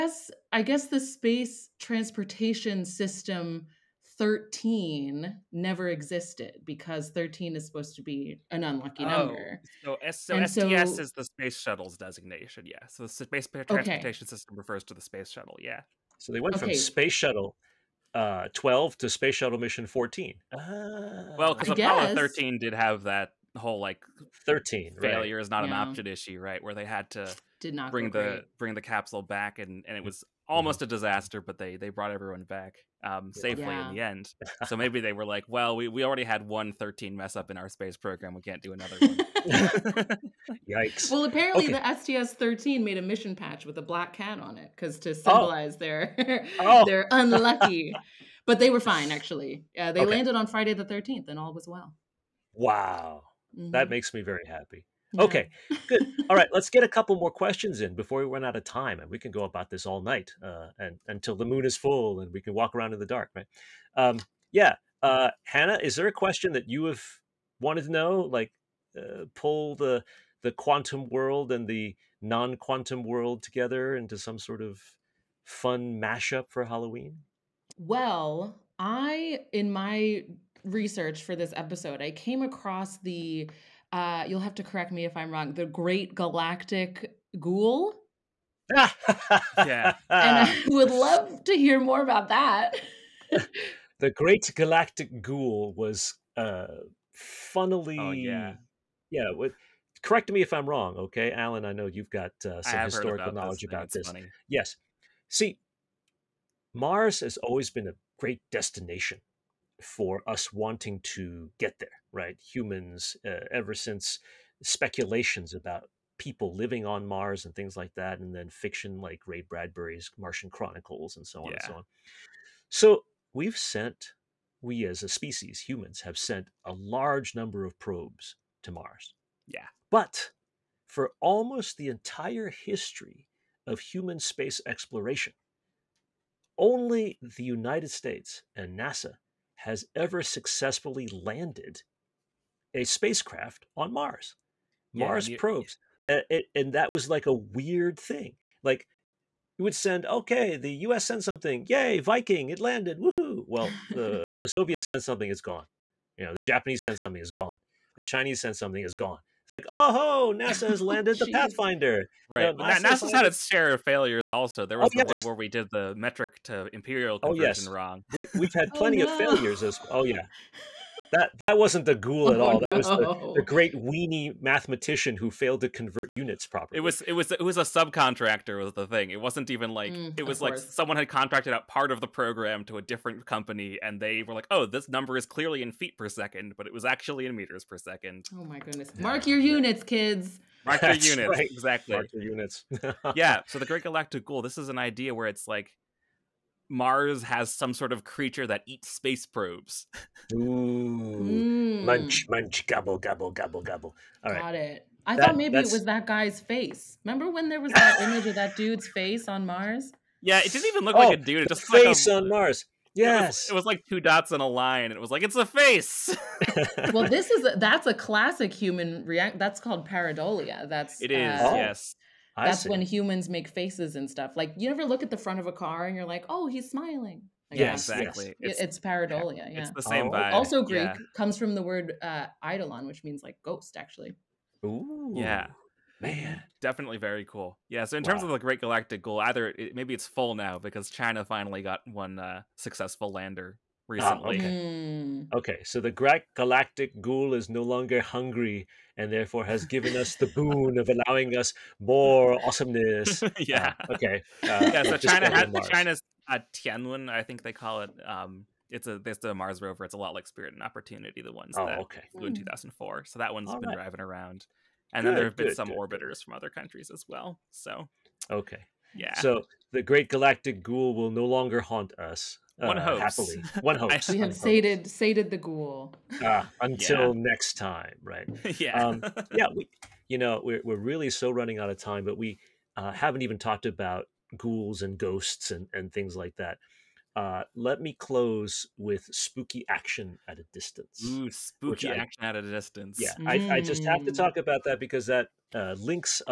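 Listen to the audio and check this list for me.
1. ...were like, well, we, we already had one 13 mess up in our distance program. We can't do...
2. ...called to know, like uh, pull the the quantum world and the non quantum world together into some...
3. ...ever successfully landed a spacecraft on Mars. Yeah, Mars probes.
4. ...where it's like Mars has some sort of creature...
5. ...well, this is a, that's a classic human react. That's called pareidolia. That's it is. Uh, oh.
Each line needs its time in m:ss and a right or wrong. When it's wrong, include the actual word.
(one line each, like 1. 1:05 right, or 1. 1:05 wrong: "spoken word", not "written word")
1. 0:35 wrong: "space", not "distance"
2. 1:07 wrong: "wanted", not "called"
3. 2:19 right
4. 3:15 right
5. 3:36 right.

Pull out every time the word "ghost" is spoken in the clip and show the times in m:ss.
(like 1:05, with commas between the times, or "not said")
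3:53, 4:44.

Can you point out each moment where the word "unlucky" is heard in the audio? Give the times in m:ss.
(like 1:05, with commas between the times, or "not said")
0:08, 0:47.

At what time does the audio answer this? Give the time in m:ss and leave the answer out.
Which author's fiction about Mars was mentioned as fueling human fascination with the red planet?
1:59.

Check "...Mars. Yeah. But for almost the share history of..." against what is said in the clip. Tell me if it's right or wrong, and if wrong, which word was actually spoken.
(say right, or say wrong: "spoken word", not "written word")
wrong: "entire", not "share".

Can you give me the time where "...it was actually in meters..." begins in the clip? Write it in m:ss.
3:06.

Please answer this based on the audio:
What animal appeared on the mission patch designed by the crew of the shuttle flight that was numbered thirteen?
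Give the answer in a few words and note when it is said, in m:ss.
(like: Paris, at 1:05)
Black cat, at 0:43.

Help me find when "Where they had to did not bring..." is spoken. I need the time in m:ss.
0:26.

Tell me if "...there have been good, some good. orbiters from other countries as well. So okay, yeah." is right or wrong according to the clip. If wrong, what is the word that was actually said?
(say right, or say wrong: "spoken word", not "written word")
right.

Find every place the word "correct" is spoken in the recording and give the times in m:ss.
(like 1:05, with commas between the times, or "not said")
1:24, 1:40.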